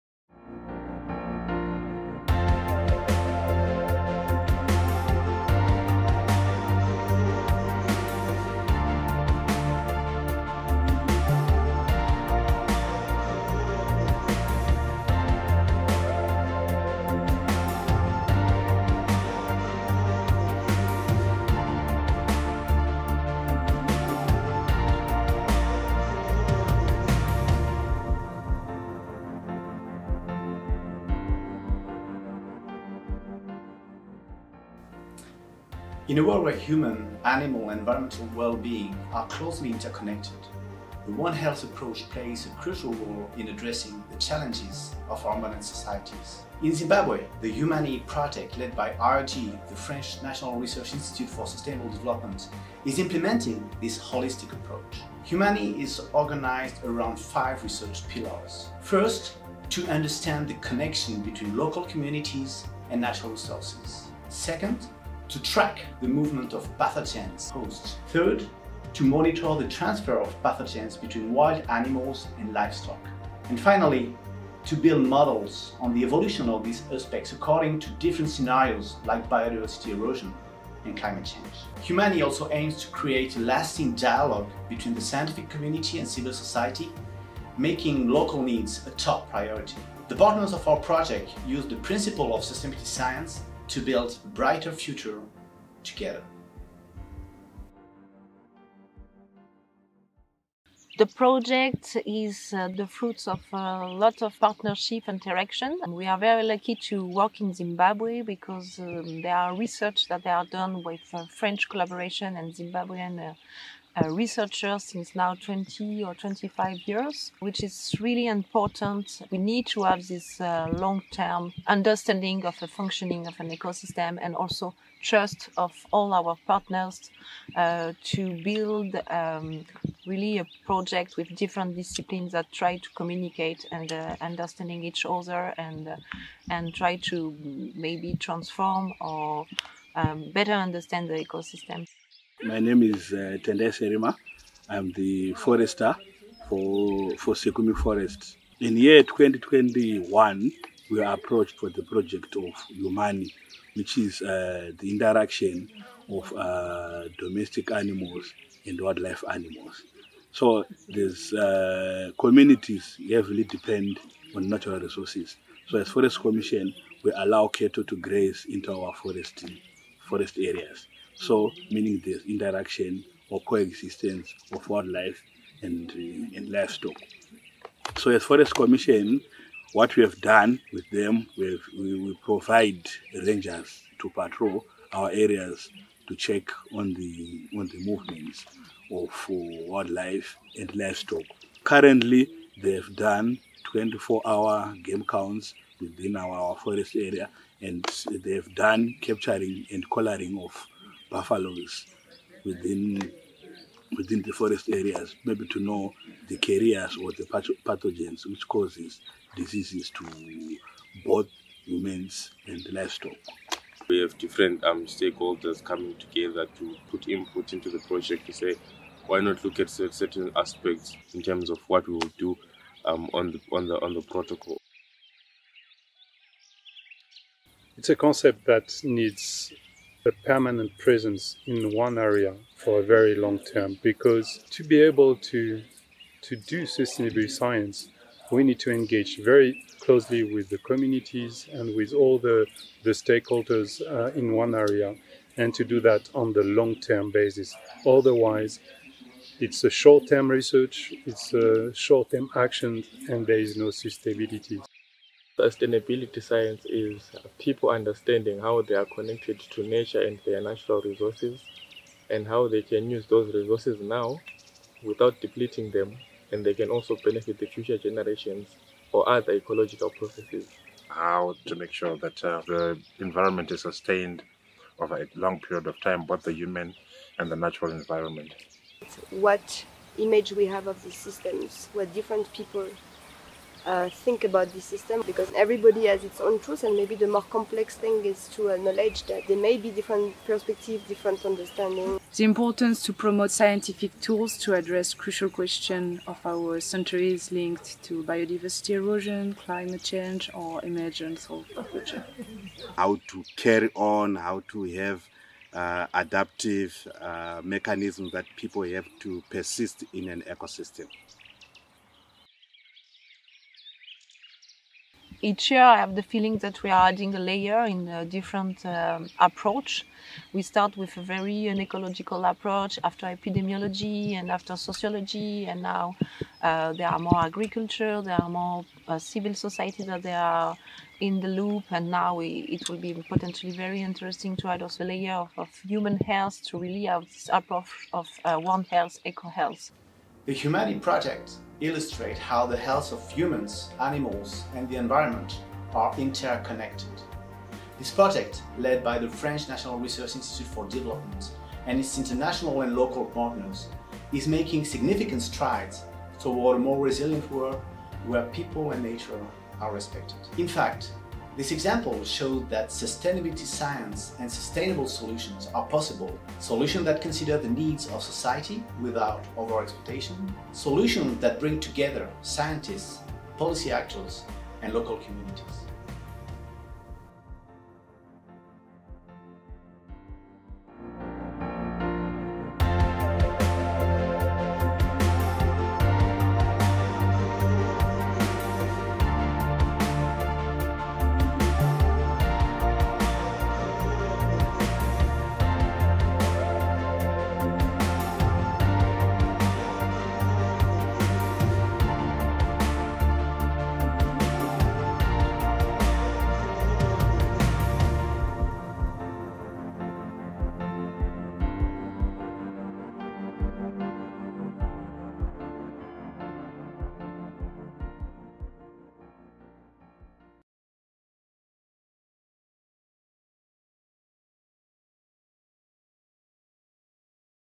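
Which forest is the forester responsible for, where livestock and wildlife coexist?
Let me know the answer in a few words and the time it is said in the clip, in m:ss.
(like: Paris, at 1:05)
Sikumi Forest, at 2:27.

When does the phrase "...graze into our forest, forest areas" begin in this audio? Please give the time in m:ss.
2:47.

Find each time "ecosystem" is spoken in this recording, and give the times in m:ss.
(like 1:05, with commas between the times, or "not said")
2:03, 2:21, 5:10.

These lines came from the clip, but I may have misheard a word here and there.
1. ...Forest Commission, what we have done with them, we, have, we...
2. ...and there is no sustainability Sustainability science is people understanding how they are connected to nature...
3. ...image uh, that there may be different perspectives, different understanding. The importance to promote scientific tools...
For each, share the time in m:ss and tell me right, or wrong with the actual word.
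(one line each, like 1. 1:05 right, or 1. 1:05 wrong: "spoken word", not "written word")
1. 2:58 right
2. 4:13 right
3. 4:48 wrong: "acknowledge", not "image".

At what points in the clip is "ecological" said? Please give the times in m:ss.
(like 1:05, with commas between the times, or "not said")
4:29, 5:21.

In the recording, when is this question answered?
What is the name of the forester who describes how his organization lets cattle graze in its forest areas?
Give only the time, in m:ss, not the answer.
2:23.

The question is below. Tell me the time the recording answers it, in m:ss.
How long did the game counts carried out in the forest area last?
3:13.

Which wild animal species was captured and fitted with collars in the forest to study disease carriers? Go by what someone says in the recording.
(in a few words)
Buffaloes.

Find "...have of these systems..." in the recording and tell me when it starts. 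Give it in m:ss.
4:40.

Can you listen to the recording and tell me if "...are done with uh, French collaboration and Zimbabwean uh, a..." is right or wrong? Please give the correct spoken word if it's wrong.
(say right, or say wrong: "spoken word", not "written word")
right.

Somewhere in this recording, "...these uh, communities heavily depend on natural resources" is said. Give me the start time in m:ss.
2:40.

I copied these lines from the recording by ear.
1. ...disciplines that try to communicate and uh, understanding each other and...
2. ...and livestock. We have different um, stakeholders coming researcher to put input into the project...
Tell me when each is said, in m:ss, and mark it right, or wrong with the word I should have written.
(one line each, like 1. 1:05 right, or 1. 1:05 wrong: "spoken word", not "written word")
1. 2:11 right
2. 3:32 wrong: "together", not "researcher".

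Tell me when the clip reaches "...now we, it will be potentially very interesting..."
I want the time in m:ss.
5:31.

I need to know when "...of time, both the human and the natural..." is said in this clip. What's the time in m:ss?
4:35.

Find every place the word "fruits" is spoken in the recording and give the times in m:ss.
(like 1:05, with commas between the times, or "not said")
1:42.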